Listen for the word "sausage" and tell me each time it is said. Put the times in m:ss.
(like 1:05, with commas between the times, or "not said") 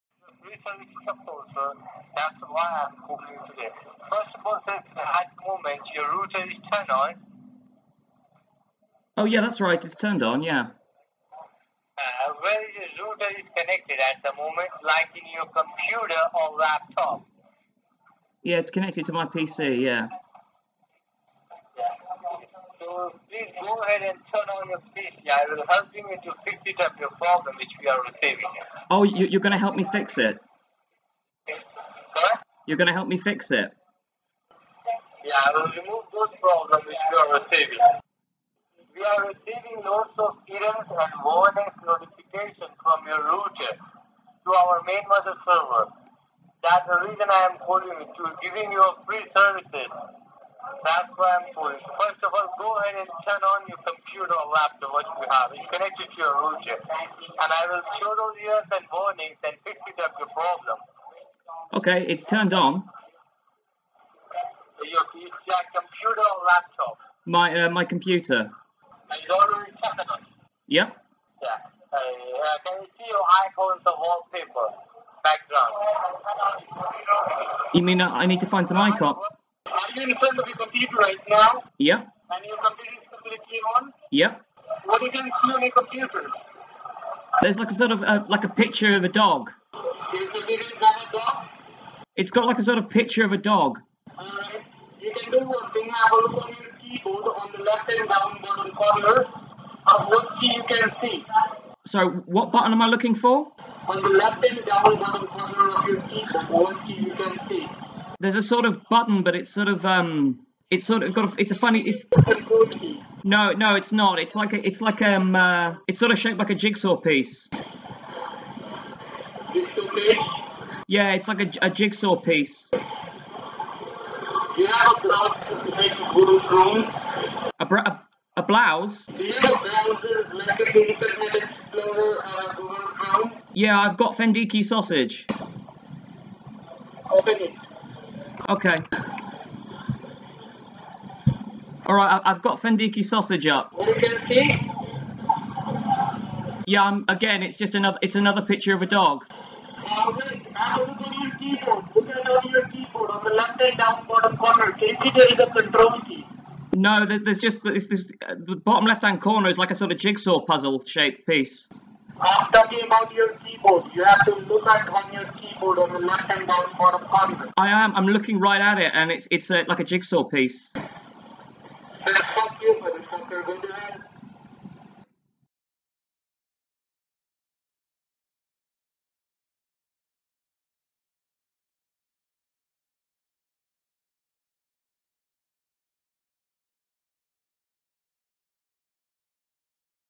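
2:14, 2:23.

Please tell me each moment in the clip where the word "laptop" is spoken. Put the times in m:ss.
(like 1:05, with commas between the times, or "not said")
0:16, 0:54, 1:06.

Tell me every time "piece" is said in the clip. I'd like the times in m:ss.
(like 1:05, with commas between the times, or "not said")
1:56, 2:02, 2:41, 2:50.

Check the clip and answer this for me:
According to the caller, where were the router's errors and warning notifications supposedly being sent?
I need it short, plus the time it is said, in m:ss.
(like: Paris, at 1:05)
Main mother server, at 0:44.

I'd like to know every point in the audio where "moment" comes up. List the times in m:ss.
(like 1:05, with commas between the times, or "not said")
0:05, 0:14.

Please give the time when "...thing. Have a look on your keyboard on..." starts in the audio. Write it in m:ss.
1:35.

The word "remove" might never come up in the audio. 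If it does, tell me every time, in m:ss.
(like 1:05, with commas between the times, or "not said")
0:35.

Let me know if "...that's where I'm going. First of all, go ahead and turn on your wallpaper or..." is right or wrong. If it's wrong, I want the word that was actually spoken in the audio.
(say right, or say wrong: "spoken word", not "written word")
wrong: "computer", not "wallpaper".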